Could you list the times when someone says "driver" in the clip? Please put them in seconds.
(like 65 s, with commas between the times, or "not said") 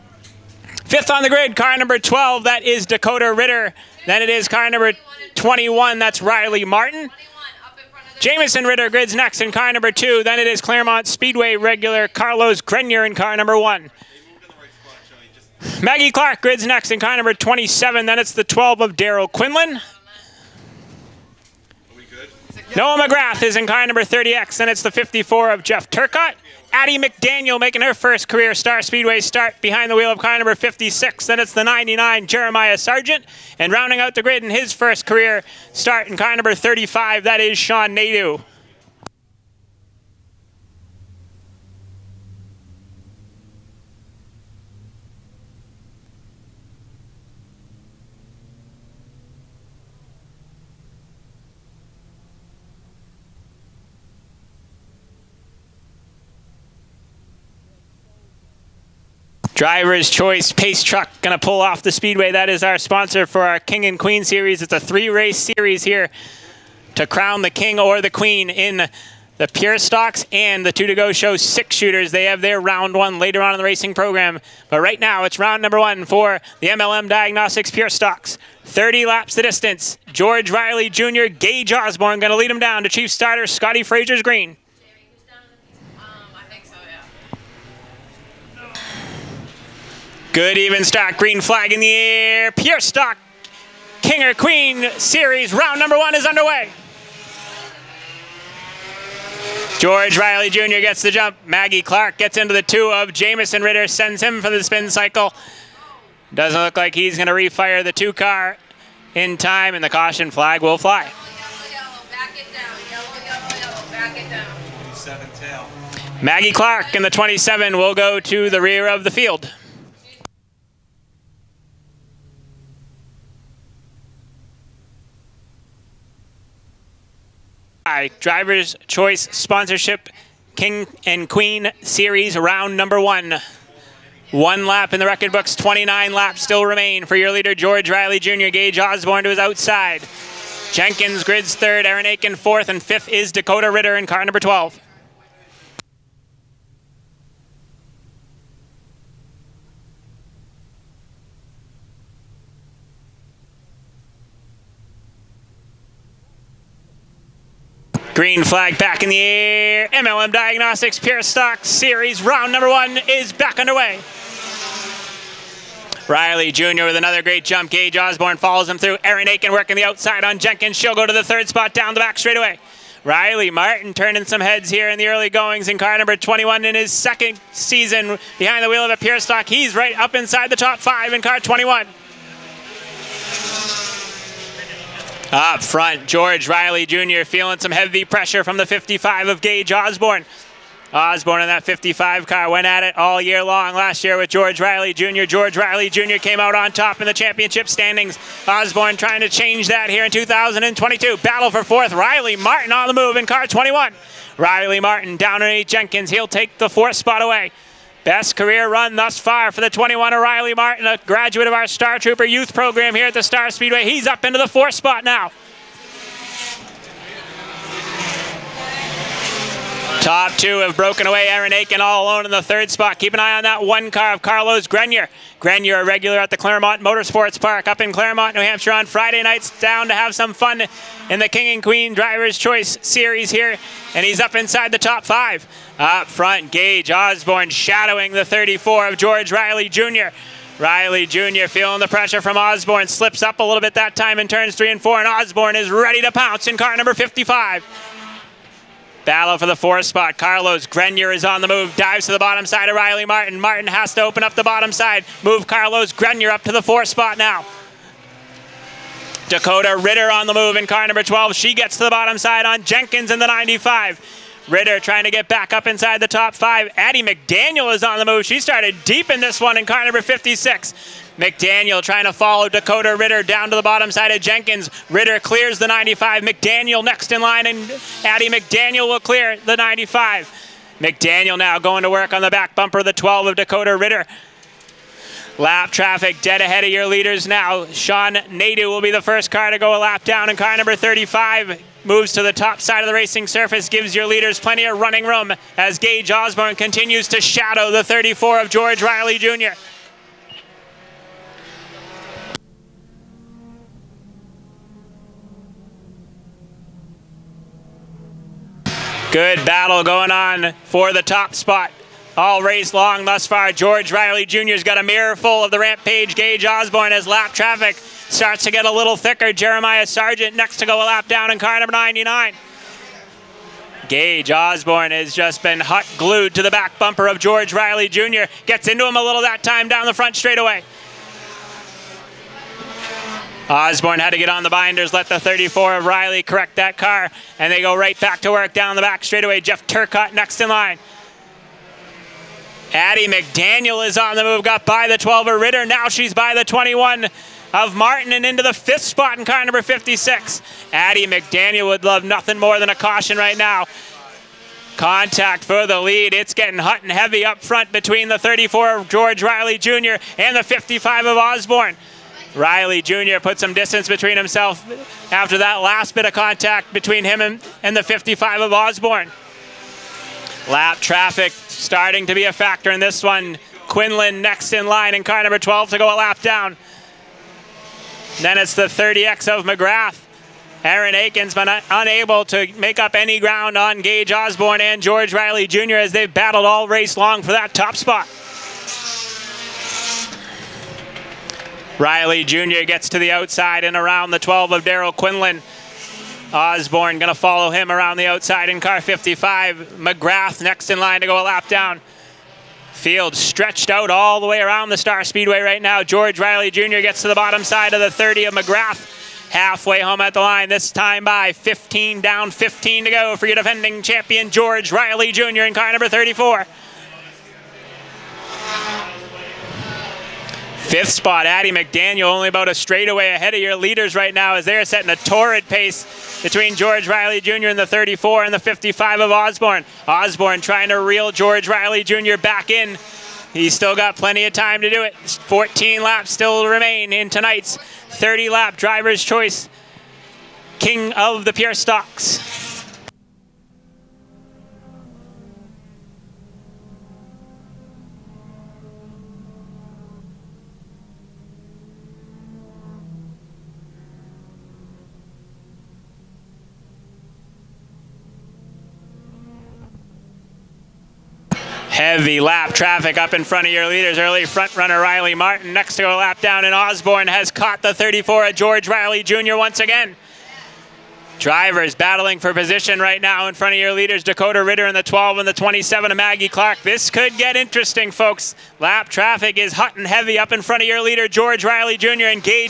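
59 s, 128 s, 231 s, 438 s, 471 s.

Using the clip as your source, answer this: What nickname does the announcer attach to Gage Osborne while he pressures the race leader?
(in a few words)
Rampage.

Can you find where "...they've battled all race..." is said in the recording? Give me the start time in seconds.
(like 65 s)
385 s.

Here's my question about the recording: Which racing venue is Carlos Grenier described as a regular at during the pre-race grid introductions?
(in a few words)
Claremont Speedway.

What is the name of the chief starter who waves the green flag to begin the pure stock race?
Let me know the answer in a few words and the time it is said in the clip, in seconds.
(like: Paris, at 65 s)
Scotty Frazier, at 83 s.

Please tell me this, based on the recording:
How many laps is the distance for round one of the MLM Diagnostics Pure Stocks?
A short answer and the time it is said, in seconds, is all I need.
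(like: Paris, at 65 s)
30, at 78 s.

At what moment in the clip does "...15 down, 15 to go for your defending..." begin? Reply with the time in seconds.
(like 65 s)
411 s.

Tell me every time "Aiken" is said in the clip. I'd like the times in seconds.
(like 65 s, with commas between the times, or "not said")
142 s, 169 s, 221 s, 380 s.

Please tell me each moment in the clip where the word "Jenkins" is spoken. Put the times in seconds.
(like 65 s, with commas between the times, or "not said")
140 s, 170 s, 205 s, 262 s, 274 s.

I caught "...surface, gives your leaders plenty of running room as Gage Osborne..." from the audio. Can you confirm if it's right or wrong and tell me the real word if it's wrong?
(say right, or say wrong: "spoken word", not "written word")
right.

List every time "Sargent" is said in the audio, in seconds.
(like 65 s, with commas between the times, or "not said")
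32 s, 319 s.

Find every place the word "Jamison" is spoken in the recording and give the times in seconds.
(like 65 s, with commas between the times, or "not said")
8 s, 103 s.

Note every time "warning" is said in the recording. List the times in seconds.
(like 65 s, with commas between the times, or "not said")
not said.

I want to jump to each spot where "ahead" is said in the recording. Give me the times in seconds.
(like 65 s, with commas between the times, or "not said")
286 s, 423 s.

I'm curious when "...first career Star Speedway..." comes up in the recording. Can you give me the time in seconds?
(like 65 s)
27 s.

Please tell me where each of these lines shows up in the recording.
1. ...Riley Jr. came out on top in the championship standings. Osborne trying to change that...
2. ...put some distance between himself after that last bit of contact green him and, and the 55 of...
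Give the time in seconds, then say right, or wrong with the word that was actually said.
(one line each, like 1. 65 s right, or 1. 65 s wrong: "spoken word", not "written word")
1. 195 s right
2. 363 s wrong: "between", not "green".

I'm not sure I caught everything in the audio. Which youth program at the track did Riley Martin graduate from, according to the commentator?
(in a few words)
Star Trooper.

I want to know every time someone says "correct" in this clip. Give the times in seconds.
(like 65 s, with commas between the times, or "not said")
336 s.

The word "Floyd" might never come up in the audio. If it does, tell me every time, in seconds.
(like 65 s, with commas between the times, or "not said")
not said.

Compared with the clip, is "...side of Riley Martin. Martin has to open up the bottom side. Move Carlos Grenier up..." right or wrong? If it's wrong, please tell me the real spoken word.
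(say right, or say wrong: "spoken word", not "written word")
right.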